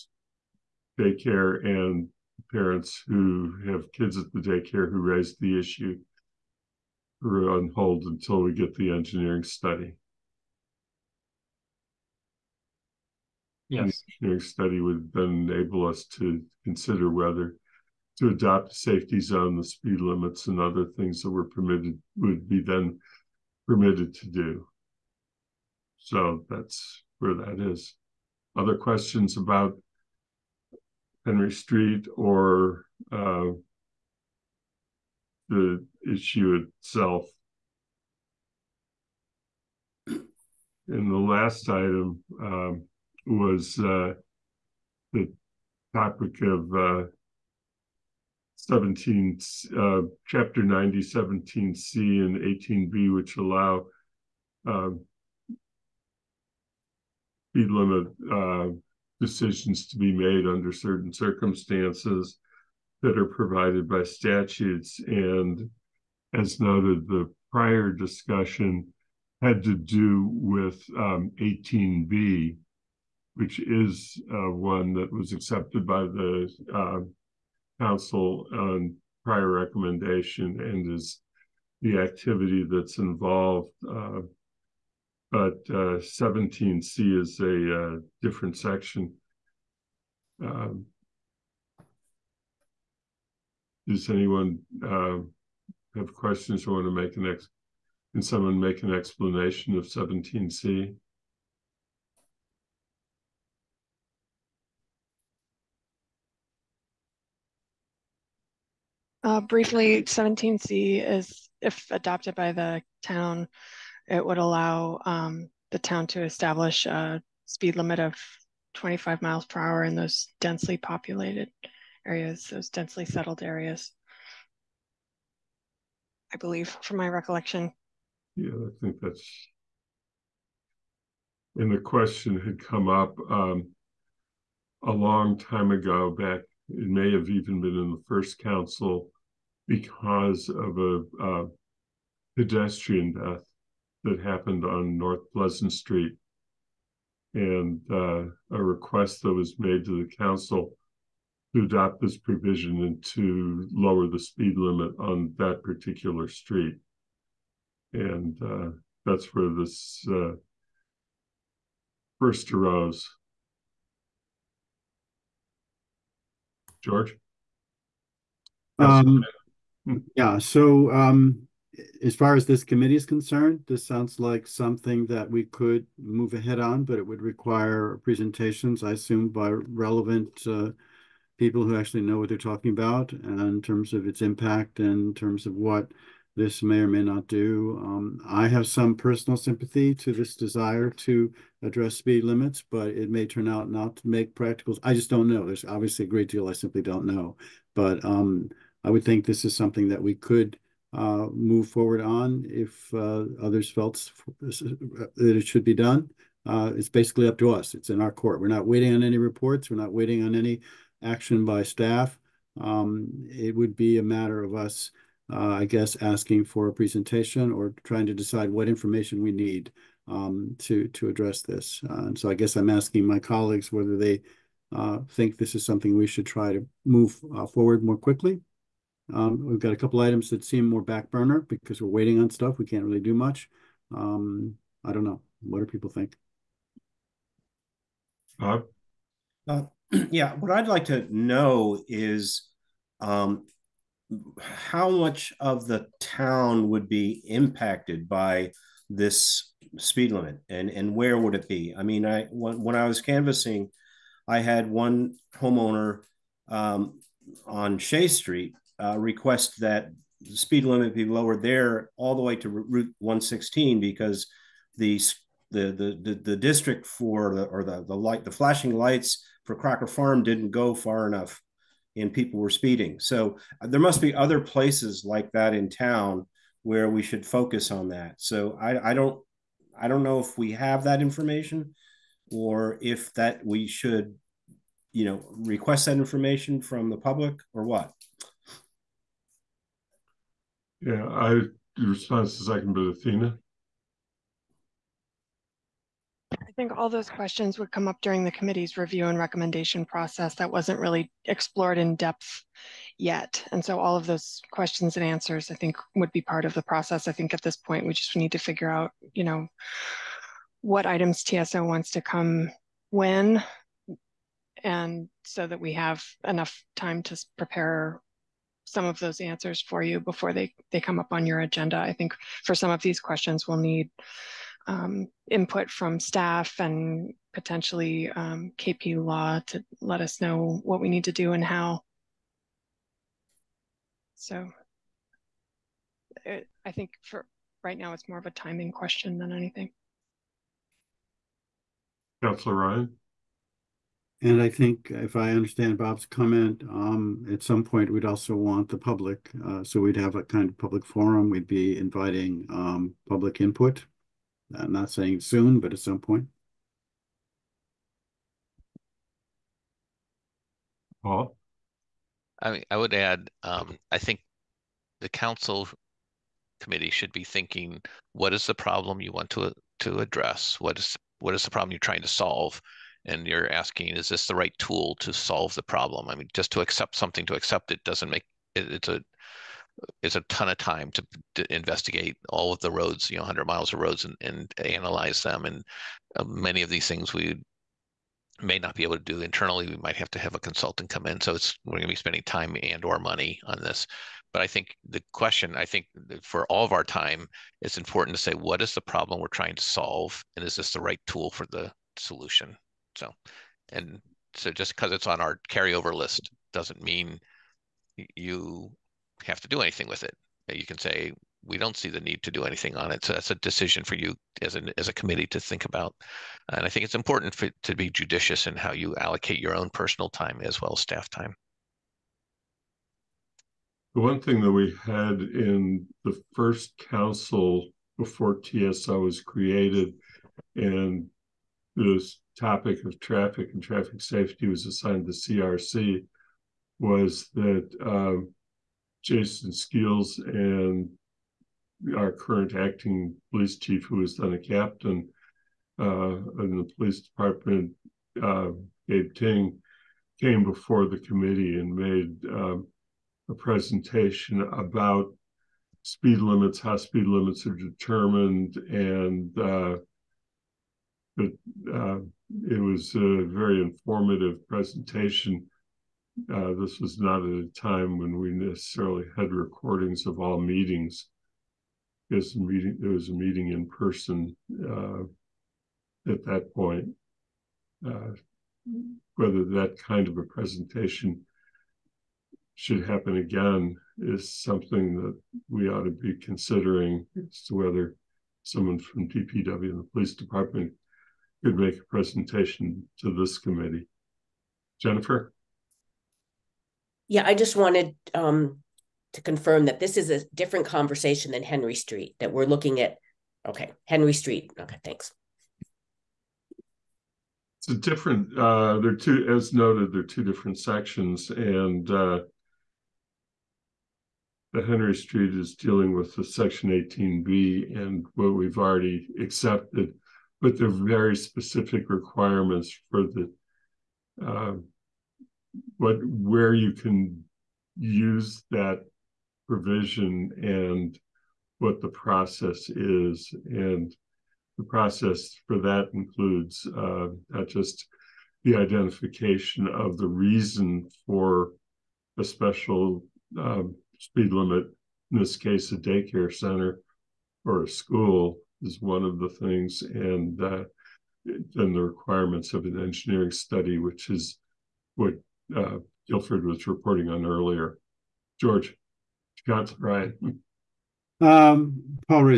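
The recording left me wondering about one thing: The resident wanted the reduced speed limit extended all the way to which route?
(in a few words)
Route 116.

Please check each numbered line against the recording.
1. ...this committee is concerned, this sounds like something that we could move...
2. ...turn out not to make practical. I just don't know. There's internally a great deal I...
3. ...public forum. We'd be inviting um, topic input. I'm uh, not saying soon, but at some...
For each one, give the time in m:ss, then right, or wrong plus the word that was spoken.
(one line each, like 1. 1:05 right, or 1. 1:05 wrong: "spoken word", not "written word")
1. 2:52 right
2. 3:13 wrong: "obviously", not "internally"
3. 5:50 wrong: "public", not "topic".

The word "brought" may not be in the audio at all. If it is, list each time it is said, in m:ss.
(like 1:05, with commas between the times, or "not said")
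not said.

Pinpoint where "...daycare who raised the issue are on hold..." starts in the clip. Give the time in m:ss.
0:04.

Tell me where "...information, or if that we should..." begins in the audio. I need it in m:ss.
4:41.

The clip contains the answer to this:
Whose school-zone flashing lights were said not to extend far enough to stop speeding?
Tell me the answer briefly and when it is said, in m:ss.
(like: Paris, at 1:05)
Crocker Farm, at 4:29.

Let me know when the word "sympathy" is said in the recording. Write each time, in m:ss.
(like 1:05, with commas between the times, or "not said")
3:09.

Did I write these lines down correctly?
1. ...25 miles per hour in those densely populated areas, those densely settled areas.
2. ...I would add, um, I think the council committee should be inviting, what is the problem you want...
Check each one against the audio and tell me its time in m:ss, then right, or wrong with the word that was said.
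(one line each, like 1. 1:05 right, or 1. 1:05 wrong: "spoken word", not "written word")
1. 1:58 right
2. 6:02 wrong: "thinking", not "inviting".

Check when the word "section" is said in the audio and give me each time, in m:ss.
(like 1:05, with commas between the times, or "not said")
1:28, 8:30, 8:36.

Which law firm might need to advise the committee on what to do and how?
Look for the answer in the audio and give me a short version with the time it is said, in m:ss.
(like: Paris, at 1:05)
KP Law, at 5:28.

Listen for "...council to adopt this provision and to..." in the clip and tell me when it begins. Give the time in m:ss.
2:30.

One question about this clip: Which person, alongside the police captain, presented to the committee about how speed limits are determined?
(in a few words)
Jason Skeels.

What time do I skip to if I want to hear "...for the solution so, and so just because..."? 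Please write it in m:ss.
6:41.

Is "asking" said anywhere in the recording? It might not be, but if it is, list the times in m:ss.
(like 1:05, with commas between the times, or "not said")
3:36, 3:42, 6:13.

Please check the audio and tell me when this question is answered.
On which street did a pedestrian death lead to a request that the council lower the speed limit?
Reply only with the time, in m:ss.
2:24.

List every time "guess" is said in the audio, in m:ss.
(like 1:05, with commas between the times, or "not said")
3:35, 3:42.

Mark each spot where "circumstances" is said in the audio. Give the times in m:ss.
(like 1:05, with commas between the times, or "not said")
1:01.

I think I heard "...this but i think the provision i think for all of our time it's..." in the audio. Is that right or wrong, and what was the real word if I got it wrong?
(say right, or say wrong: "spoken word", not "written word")
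wrong: "question", not "provision".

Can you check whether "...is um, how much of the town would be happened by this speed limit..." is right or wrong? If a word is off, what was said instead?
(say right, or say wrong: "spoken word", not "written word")
wrong: "impacted", not "happened".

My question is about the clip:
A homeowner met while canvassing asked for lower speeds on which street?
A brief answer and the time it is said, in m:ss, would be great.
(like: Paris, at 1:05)
Shea Street, at 4:17.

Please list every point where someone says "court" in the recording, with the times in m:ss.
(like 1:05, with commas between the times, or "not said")
3:28.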